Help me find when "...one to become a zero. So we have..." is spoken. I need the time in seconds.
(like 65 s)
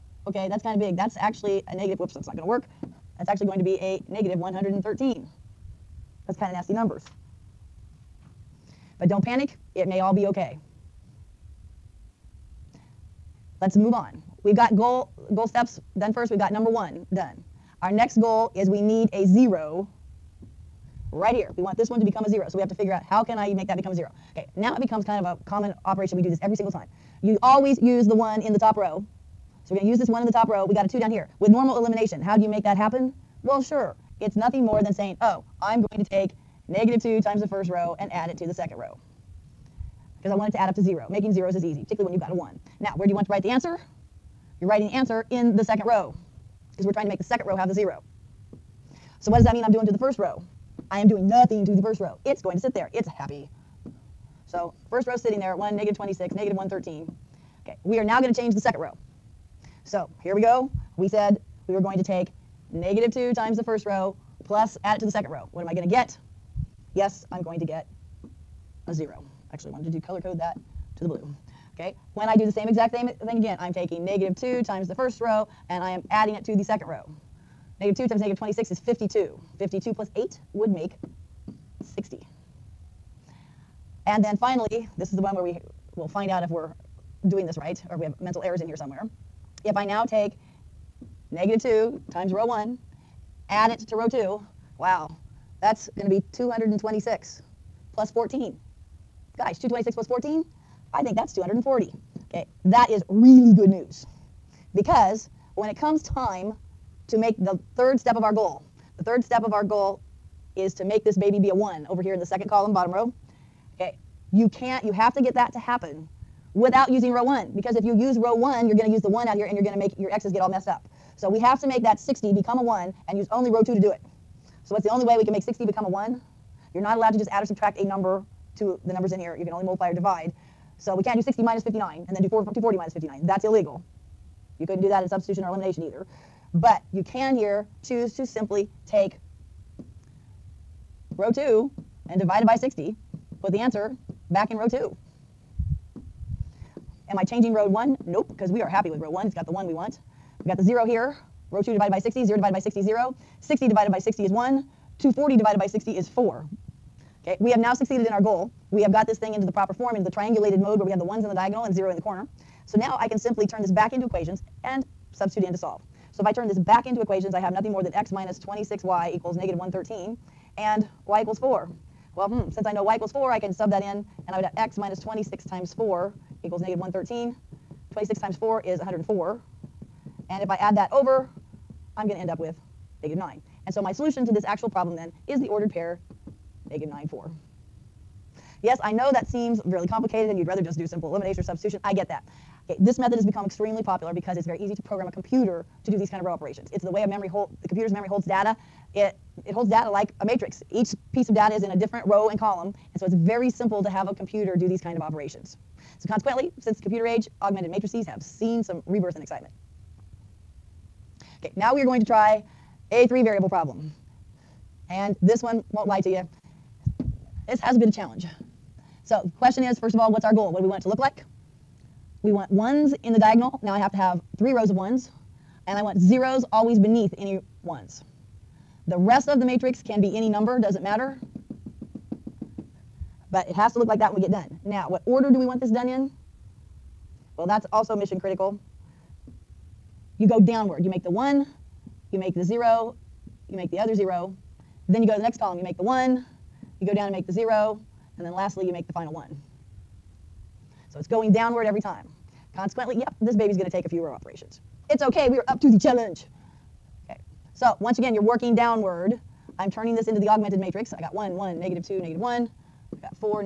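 21 s.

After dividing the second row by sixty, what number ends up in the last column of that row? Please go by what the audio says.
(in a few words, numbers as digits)
4.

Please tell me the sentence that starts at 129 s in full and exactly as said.
You can only multiply or divide.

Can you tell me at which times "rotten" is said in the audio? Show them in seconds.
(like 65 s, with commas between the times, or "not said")
not said.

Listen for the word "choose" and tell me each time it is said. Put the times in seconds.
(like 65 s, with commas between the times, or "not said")
137 s.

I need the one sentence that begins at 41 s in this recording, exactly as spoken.
Making zeros is easy, particularly when you've got a one.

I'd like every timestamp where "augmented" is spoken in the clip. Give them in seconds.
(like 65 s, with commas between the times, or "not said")
207 s, 260 s.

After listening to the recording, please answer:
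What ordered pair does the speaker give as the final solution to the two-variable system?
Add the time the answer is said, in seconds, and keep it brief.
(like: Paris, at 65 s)
(-9, 4), at 186 s.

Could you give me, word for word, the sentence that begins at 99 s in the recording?
Gosh, 226 plus 14, I think that's 240.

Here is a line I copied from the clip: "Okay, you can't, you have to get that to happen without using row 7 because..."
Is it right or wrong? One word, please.
wrong.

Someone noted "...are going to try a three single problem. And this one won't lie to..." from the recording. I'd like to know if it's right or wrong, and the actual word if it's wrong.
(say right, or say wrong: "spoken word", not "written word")
wrong: "variable", not "single".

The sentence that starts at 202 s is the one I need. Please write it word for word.
And so it's very simple to have a computer do these kind of operations.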